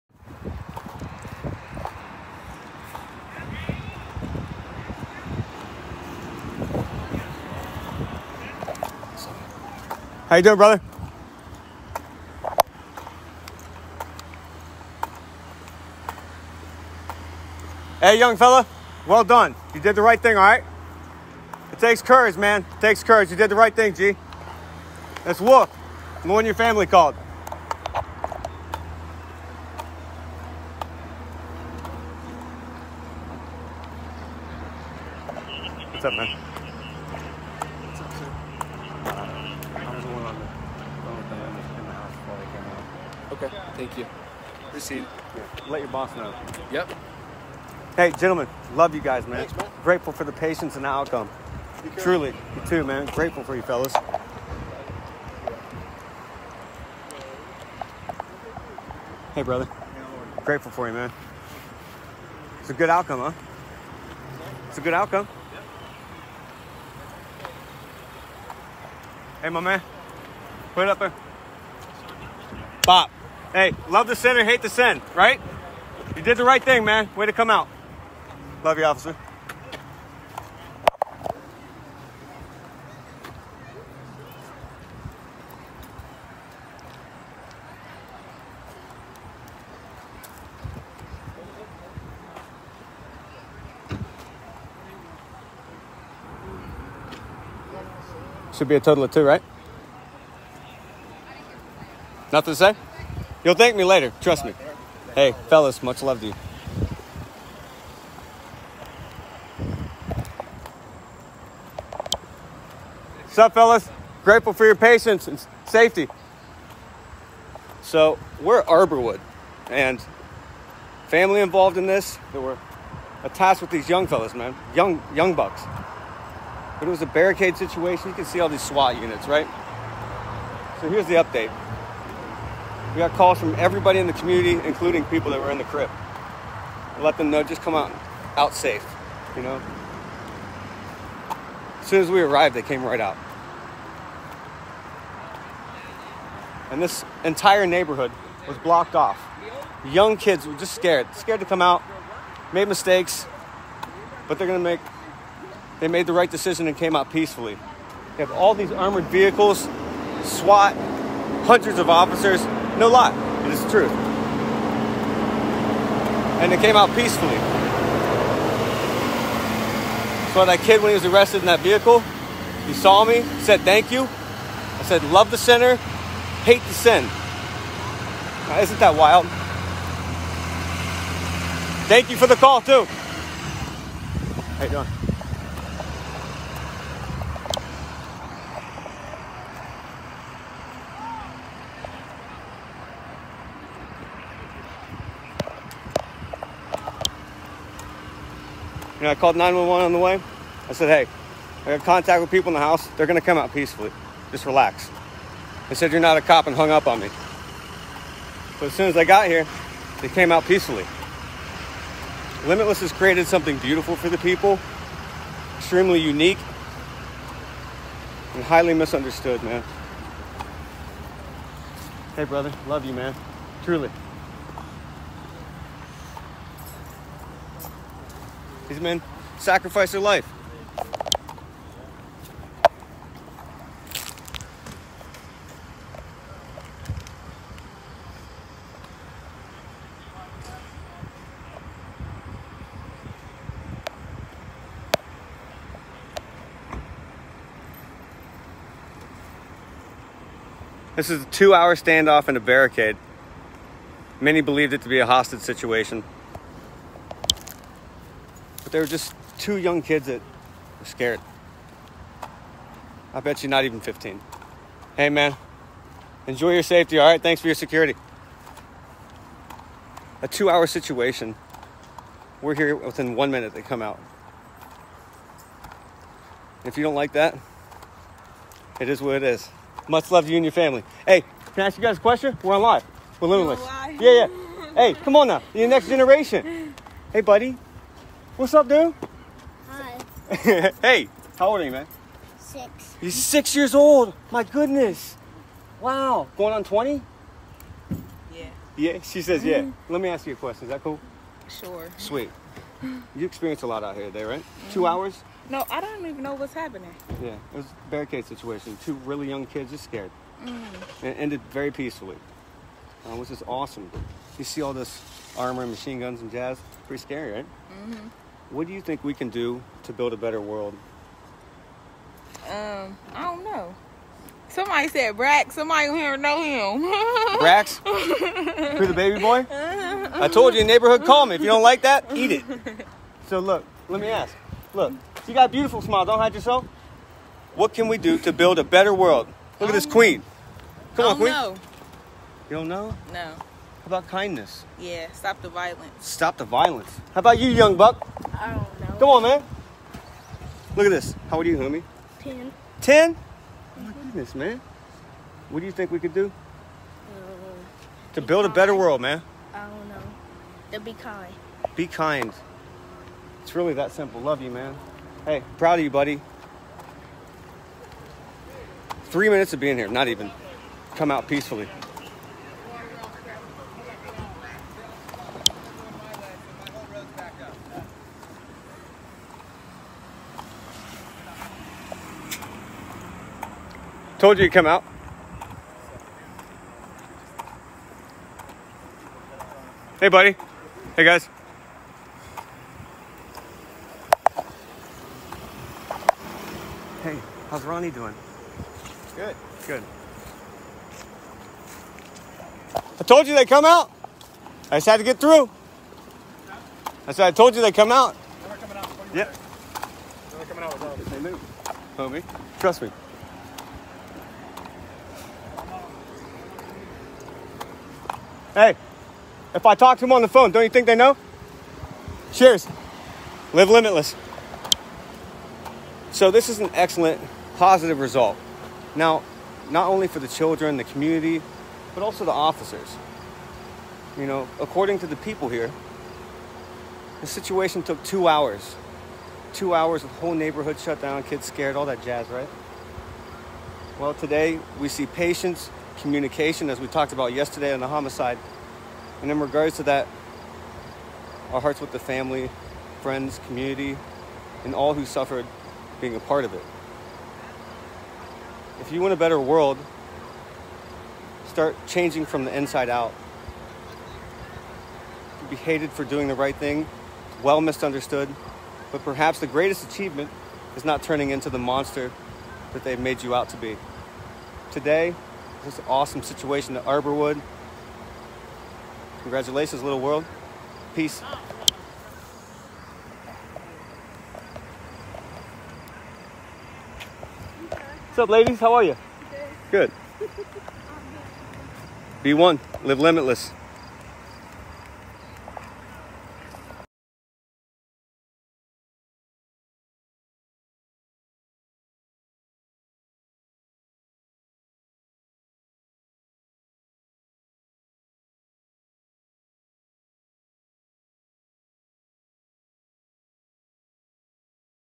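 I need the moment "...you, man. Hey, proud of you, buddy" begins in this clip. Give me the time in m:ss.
6:04.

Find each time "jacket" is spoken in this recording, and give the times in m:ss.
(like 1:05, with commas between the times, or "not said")
not said.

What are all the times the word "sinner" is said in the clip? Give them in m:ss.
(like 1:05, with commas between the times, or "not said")
1:14, 2:55.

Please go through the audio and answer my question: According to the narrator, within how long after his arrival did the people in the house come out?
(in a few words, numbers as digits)
1 minute.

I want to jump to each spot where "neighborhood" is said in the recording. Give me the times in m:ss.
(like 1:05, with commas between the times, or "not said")
2:27, 5:30, 7:20.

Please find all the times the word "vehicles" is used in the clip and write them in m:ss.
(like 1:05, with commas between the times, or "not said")
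2:39, 2:51.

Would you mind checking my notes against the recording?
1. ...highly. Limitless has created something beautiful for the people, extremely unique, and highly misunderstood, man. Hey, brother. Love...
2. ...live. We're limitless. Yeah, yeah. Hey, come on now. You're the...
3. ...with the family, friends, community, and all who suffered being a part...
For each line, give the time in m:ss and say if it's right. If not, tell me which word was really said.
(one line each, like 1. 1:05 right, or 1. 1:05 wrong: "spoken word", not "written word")
1. 3:30 wrong: "peacefully", not "highly"
2. 4:42 right
3. 7:31 right.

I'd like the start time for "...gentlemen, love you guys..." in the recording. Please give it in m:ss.
0:48.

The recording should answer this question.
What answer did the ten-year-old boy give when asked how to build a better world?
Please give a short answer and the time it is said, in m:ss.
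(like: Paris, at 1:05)
To be kind, at 6:00.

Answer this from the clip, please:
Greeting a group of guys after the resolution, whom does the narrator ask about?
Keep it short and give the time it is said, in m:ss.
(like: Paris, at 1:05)
Ronnie, at 6:37.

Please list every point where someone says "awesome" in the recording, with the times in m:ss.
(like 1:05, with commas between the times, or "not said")
5:13, 7:55.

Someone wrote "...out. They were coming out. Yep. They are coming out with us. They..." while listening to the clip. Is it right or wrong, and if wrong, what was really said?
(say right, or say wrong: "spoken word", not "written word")
right.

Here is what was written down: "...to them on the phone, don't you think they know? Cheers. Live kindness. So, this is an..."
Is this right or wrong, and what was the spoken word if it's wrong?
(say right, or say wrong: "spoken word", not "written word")
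wrong: "limitless", not "kindness".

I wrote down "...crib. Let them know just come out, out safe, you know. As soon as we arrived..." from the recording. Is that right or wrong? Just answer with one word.
right.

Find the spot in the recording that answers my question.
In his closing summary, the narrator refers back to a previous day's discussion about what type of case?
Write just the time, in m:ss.
7:27.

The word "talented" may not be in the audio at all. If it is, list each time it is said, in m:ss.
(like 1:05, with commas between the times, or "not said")
not said.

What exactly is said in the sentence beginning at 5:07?
Yeah, it was a barricade situation.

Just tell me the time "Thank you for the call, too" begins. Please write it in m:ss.
3:01.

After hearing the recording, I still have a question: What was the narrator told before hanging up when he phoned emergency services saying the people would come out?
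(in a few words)
You're not a cop.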